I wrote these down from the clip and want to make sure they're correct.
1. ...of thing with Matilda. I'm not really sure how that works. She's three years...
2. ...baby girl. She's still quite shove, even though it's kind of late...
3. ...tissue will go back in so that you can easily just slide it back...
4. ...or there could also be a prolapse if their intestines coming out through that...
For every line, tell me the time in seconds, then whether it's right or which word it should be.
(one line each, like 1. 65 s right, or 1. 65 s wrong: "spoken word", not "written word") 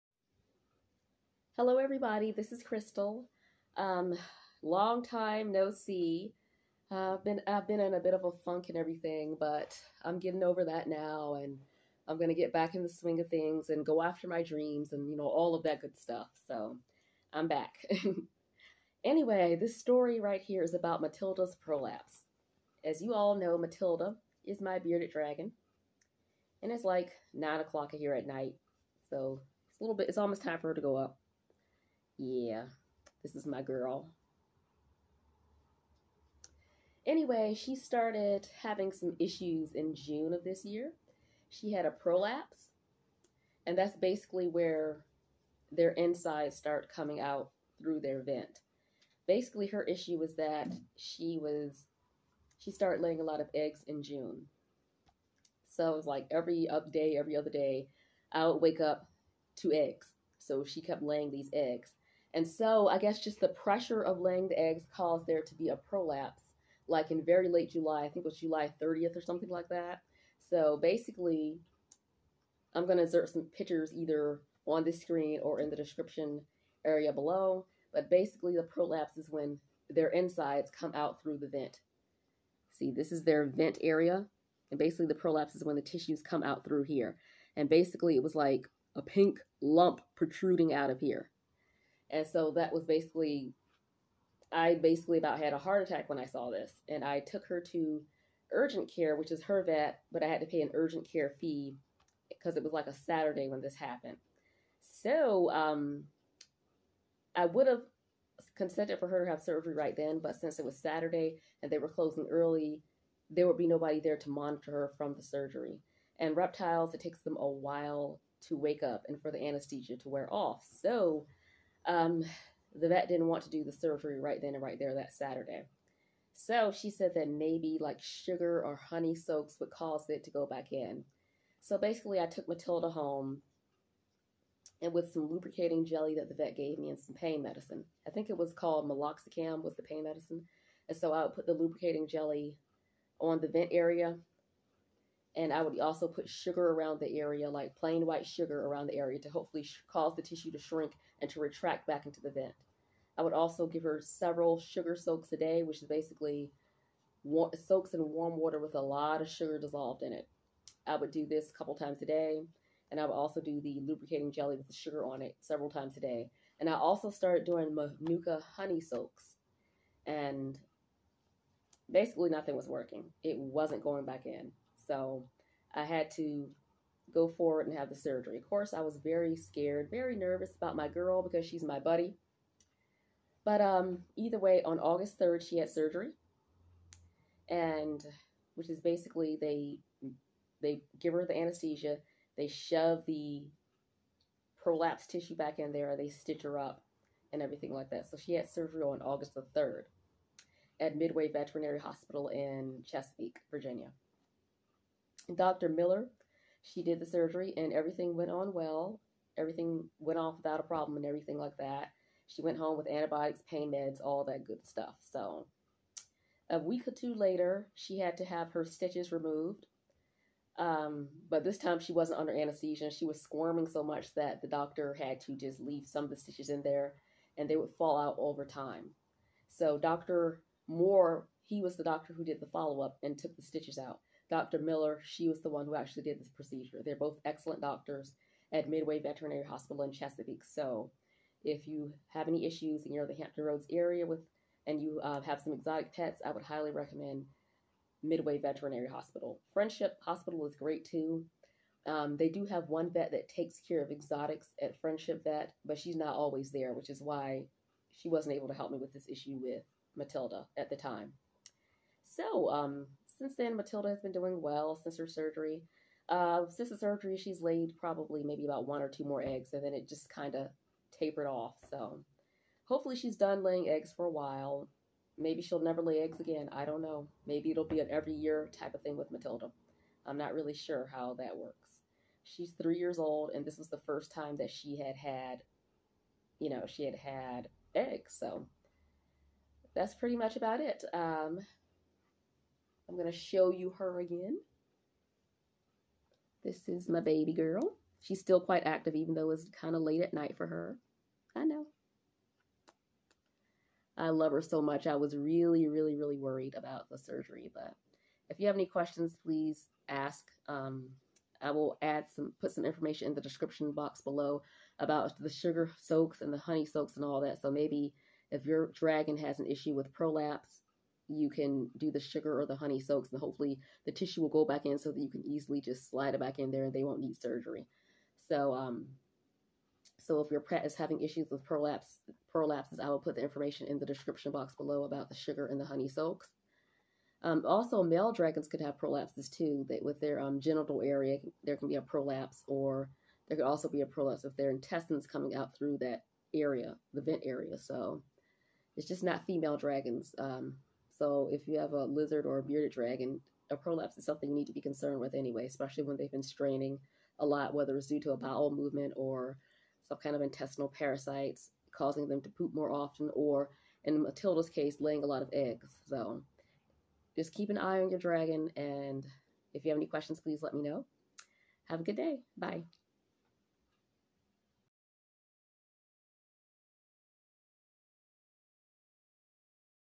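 1. 278 s right
2. 296 s wrong: "active", not "shove"
3. 323 s right
4. 342 s right.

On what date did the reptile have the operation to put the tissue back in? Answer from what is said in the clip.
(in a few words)
August 3rd.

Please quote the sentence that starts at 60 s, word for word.
So she kept laying these eggs.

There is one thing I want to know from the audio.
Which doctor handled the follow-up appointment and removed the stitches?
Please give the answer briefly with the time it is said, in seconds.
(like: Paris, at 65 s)
Dr. Moore, at 229 s.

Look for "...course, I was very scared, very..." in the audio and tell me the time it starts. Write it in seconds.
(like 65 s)
178 s.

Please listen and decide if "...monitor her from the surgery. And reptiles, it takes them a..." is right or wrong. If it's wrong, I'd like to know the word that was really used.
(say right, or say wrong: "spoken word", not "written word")
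right.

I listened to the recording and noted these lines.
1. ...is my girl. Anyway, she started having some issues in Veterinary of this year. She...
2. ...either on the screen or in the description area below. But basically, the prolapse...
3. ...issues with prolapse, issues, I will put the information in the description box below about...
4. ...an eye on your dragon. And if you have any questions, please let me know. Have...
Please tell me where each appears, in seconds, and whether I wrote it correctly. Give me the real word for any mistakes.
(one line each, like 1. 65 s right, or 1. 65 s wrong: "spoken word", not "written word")
1. 33 s wrong: "June", not "Veterinary"
2. 73 s right
3. 331 s wrong: "prolapses", not "issues"
4. 367 s right.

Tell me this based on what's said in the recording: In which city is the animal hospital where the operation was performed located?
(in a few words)
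Chesapeake, Virginia.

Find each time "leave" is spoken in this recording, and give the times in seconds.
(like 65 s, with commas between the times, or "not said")
225 s.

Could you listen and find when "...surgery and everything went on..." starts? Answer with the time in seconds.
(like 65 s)
207 s.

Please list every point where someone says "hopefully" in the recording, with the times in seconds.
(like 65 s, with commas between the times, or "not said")
149 s, 272 s, 323 s.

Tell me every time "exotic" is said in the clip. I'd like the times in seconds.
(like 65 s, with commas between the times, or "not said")
245 s, 253 s.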